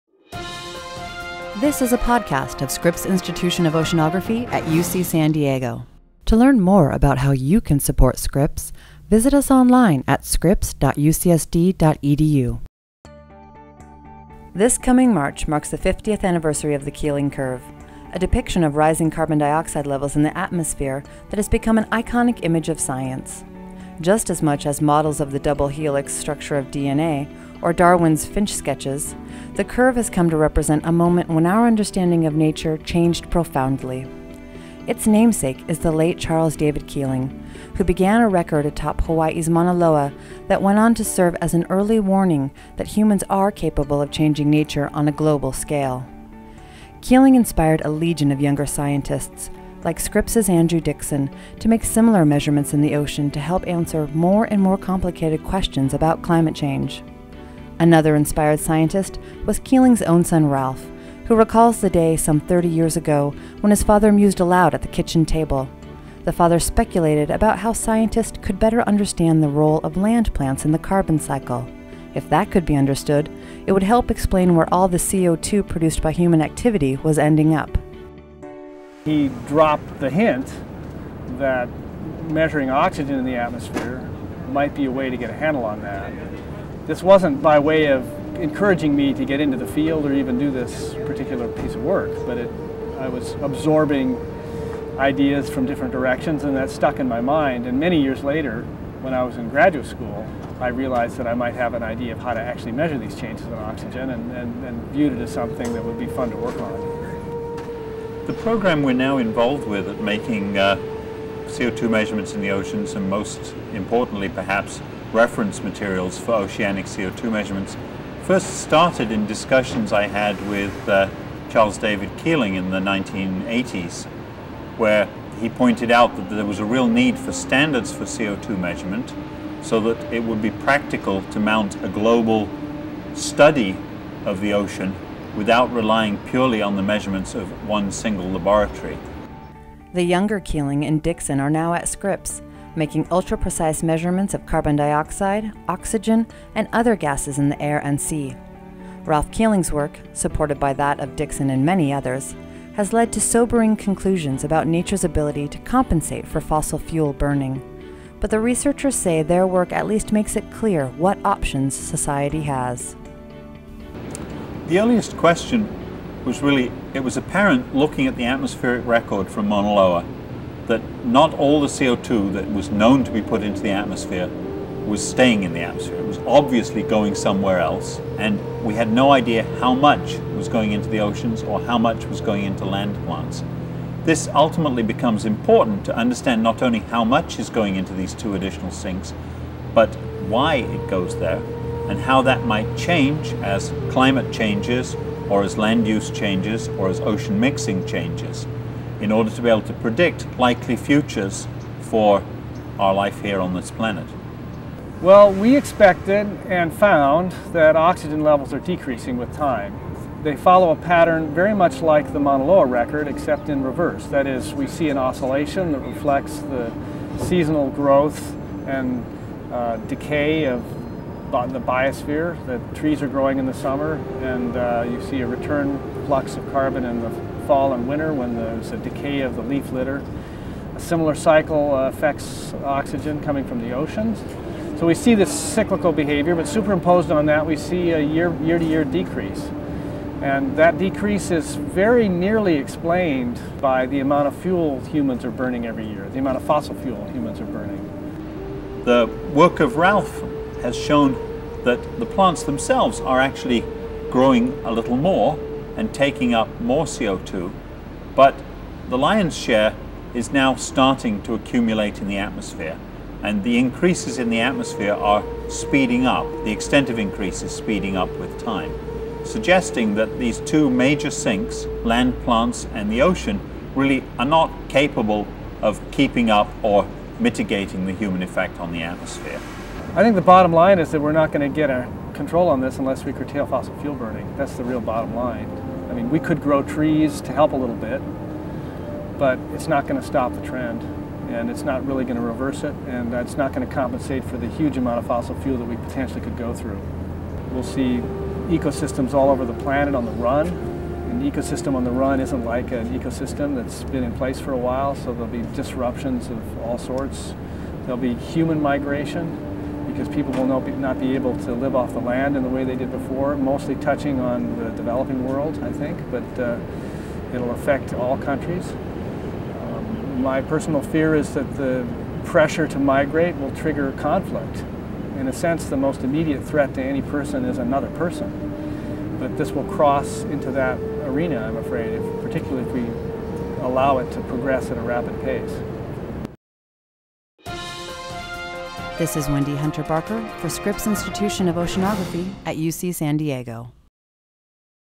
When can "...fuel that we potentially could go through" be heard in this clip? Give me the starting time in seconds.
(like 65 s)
295 s.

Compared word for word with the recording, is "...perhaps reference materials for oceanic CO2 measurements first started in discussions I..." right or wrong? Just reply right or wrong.
right.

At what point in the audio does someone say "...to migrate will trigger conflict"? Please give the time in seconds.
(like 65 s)
322 s.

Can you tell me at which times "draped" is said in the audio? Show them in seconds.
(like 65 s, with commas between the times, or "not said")
not said.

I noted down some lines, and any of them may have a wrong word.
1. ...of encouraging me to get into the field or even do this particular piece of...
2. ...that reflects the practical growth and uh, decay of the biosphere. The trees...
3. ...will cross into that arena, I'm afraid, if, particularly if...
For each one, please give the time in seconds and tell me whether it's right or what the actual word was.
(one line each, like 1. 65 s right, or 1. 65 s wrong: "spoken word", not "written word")
1. 87 s right
2. 215 s wrong: "seasonal", not "practical"
3. 329 s right.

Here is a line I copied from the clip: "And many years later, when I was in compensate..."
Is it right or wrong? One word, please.
wrong.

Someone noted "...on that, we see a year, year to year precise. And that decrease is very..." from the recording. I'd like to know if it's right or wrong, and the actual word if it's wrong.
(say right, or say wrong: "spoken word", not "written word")
wrong: "decrease", not "precise".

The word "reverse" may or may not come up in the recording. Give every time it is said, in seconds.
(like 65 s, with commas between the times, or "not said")
213 s, 292 s.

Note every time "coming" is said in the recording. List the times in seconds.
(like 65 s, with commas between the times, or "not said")
14 s, 233 s.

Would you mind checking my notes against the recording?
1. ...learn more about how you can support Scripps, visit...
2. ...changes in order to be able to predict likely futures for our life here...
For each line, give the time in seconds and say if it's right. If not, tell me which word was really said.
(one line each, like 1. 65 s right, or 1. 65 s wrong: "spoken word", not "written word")
1. 6 s right
2. 197 s right.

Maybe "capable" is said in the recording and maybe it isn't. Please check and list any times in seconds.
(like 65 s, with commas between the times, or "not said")
43 s, 274 s.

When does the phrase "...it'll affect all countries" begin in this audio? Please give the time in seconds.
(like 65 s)
317 s.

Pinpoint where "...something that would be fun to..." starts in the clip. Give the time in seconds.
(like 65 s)
105 s.